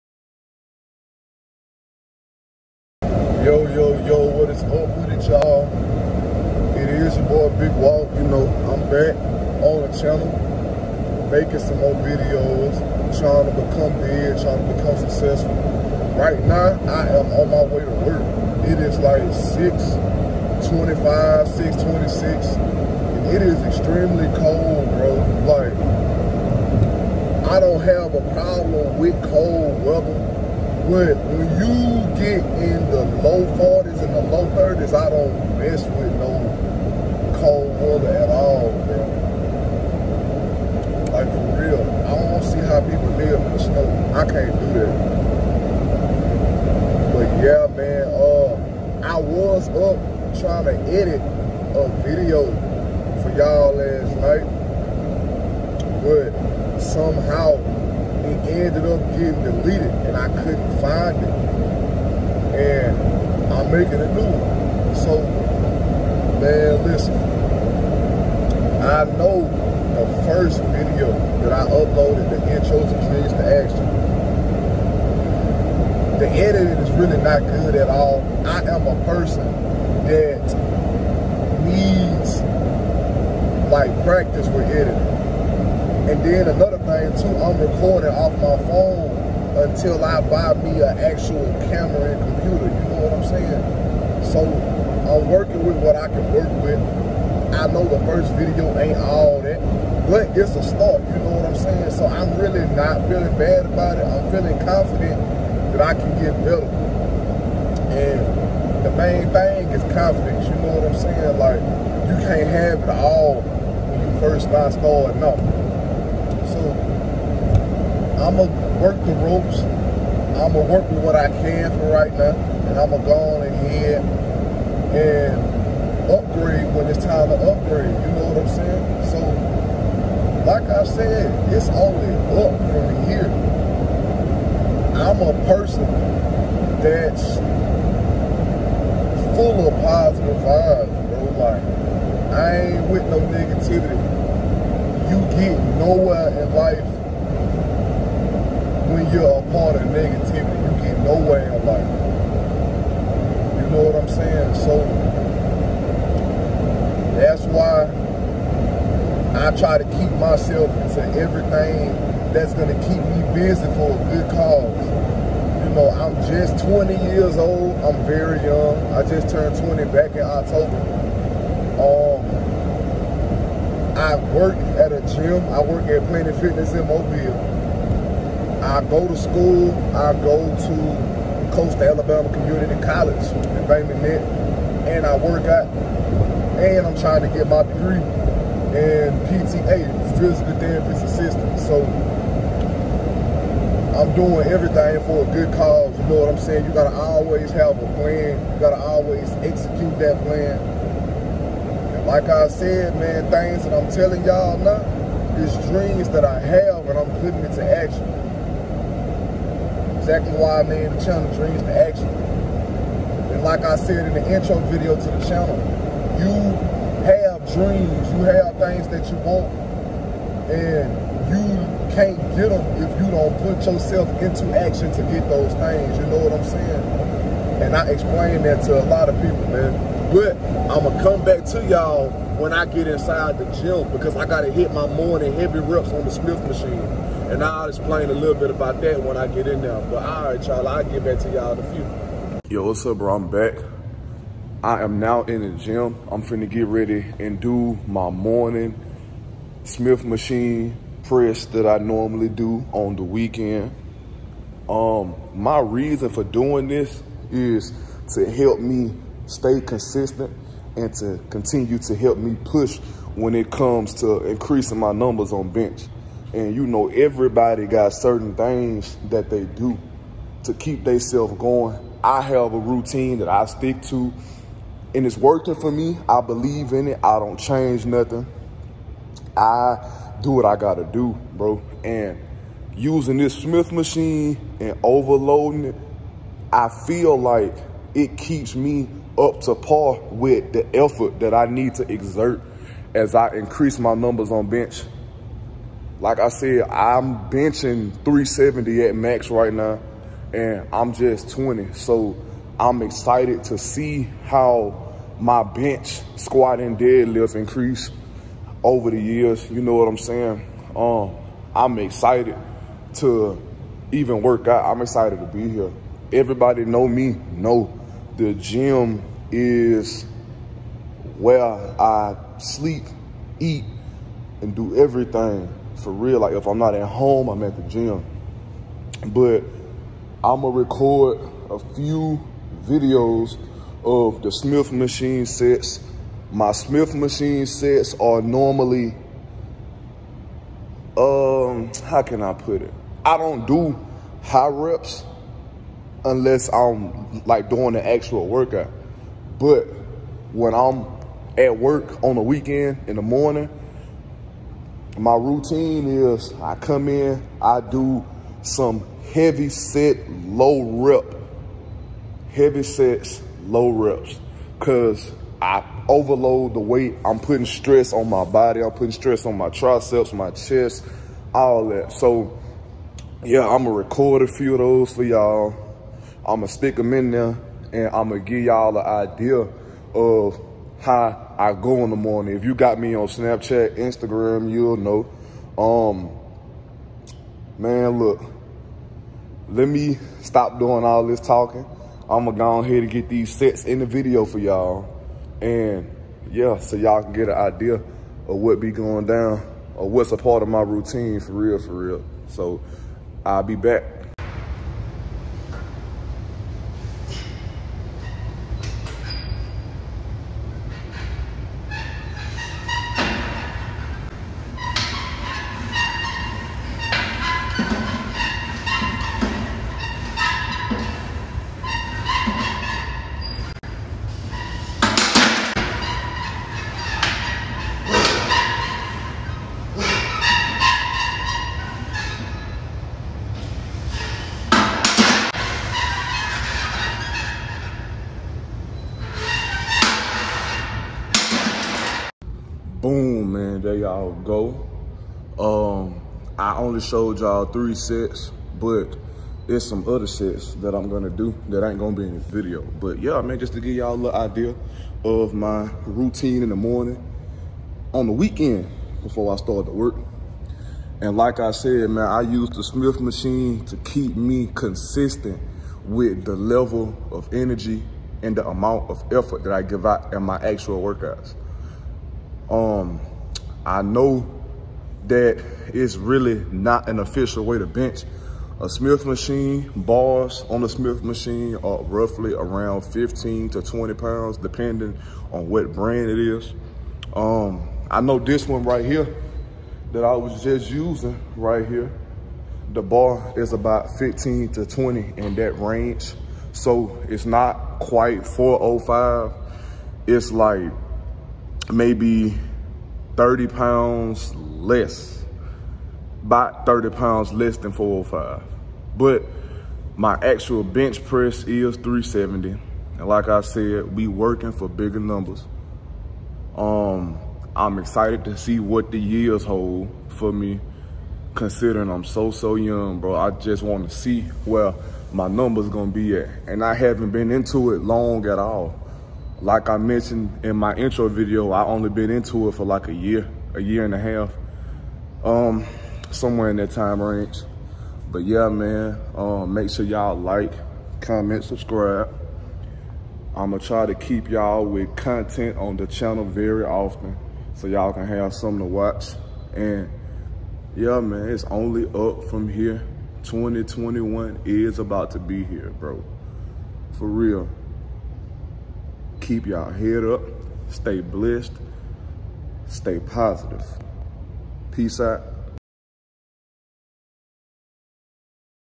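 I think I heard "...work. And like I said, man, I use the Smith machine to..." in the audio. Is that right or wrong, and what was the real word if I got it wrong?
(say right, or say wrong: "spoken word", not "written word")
right.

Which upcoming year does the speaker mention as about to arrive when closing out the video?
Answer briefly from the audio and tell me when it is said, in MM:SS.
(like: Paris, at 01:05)
2021, at 09:13.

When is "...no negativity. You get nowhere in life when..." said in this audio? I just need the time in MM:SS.
02:23.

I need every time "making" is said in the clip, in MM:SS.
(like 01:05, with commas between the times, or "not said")
00:11, 01:03.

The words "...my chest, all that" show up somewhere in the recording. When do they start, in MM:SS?
06:10.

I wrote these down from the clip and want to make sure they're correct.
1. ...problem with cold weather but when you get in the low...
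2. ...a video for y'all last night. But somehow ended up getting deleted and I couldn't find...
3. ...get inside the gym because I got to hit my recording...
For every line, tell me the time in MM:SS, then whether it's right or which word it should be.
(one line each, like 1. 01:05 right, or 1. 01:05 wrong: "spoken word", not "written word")
1. 00:28 right
2. 00:51 right
3. 03:52 wrong: "morning", not "recording".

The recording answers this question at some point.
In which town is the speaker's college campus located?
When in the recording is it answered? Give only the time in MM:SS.
03:03.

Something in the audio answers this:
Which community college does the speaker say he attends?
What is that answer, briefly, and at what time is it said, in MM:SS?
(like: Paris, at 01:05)
Coastal Alabama Community College, at 03:01.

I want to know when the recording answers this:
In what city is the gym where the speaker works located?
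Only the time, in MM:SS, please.
02:56.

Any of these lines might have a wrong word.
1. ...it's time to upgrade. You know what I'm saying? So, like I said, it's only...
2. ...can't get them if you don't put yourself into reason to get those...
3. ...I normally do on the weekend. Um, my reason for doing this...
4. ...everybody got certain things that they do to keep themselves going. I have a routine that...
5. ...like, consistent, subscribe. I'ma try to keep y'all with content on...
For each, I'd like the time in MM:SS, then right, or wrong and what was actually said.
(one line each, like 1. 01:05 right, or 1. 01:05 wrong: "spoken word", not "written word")
1. 02:06 right
2. 03:41 wrong: "action", not "reason"
3. 04:11 right
4. 04:26 right
5. 09:00 wrong: "comment", not "consistent".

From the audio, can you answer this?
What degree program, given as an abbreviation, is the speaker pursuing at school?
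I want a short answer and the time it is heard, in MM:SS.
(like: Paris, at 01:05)
PTA, at 03:09.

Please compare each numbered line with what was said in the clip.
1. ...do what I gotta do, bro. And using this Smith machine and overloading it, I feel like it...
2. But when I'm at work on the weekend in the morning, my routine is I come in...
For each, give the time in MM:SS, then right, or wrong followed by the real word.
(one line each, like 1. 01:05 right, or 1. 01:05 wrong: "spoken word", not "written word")
1. 04:40 right
2. 05:49 right.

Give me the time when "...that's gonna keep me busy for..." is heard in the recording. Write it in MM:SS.
02:42.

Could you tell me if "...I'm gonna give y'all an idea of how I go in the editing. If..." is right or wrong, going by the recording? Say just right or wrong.
wrong.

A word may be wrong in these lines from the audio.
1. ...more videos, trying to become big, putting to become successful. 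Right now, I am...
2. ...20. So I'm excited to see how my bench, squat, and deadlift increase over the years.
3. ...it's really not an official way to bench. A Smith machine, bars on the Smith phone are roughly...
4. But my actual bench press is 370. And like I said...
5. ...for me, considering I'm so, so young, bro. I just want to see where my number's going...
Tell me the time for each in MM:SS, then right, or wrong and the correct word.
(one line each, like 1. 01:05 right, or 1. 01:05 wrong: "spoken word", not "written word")
1. 00:11 wrong: "trying", not "putting"
2. 05:01 right
3. 07:55 wrong: "machine", not "phone"
4. 08:28 right
5. 08:40 right.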